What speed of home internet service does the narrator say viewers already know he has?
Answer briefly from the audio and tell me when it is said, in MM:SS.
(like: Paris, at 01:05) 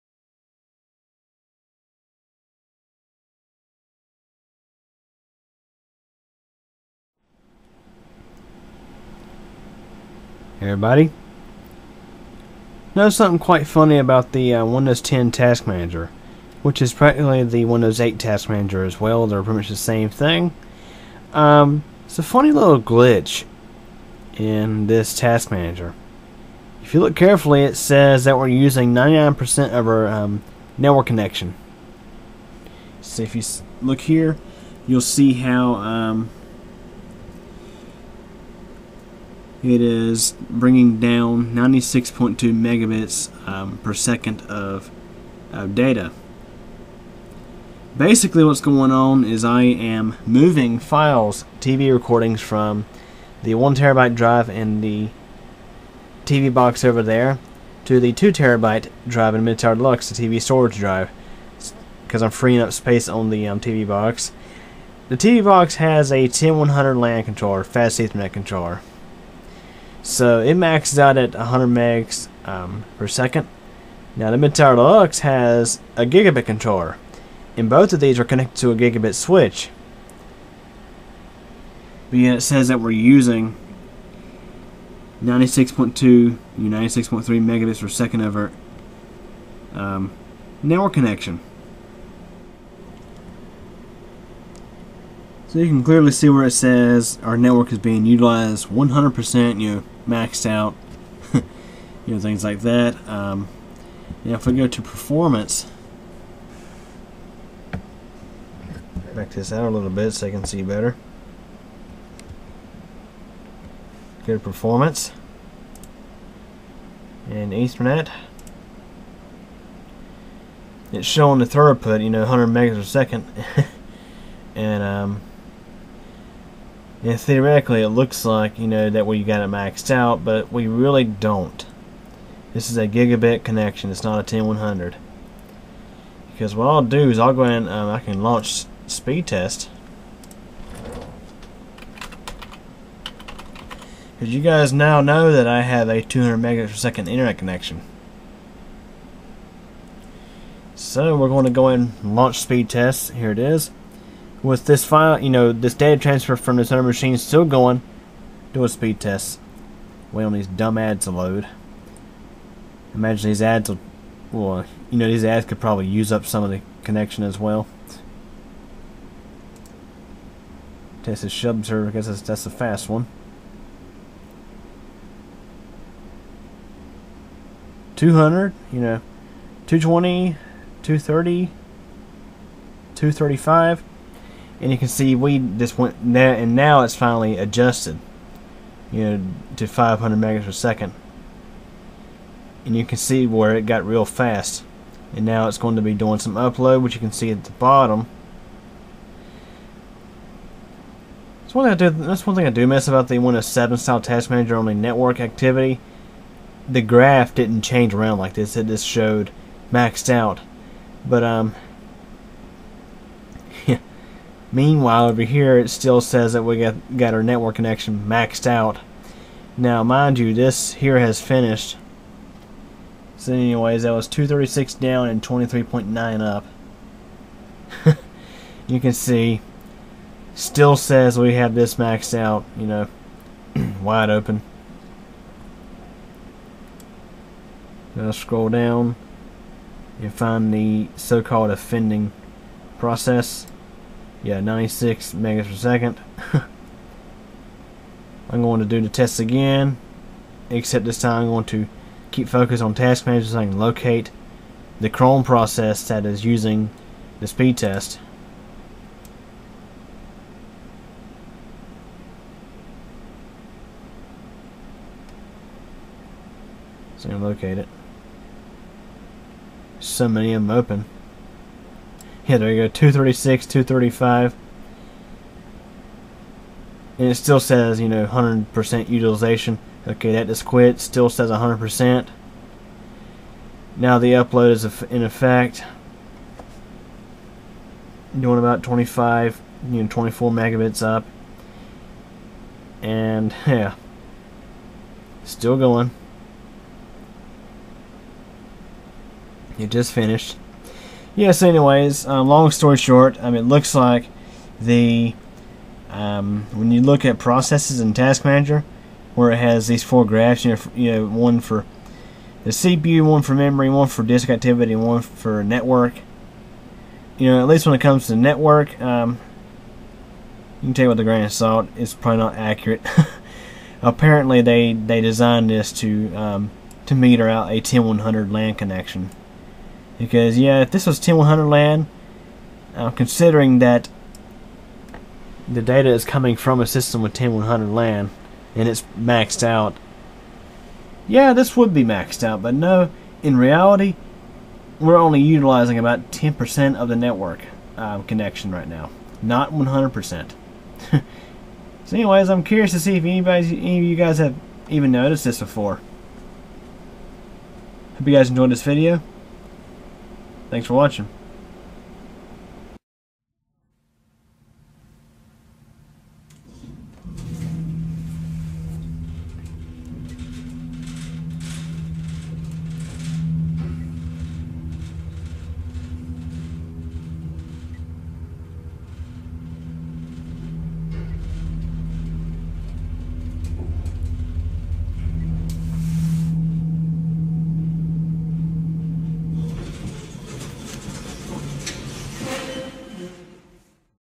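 200 megabits per second, at 02:26.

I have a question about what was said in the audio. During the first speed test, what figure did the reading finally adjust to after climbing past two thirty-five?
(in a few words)
500 megabits per second.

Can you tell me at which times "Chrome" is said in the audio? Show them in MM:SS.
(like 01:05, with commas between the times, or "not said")
04:14.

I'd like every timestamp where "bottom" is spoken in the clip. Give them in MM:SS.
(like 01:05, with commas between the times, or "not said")
03:17.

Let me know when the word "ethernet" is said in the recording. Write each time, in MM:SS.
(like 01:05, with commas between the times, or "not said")
01:07, 01:57.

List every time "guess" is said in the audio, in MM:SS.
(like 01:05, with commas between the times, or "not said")
02:51.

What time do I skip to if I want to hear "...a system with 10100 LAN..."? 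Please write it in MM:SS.
05:36.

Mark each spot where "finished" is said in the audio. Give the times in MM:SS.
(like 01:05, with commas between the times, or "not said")
03:41, 04:59.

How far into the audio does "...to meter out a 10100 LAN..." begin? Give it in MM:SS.
05:26.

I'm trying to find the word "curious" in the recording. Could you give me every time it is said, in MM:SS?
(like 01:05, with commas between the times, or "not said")
05:52.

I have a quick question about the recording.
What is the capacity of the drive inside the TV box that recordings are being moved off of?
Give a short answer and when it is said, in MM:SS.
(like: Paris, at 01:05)
1 terabyte, at 00:53.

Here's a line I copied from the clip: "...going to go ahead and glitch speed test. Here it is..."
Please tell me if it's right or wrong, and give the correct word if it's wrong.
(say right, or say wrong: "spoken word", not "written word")
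wrong: "launch", not "glitch".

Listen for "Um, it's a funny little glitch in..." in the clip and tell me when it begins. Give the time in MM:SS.
00:21.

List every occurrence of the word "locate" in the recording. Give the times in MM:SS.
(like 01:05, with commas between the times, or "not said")
04:13, 04:27.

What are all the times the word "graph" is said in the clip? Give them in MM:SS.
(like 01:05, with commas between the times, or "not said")
03:26, 05:10.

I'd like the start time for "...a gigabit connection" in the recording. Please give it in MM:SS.
02:12.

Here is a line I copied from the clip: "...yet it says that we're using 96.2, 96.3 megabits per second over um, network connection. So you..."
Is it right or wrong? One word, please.
right.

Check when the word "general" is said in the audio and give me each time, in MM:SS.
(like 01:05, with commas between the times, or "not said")
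not said.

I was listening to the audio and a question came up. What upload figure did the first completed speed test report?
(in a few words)
23.9.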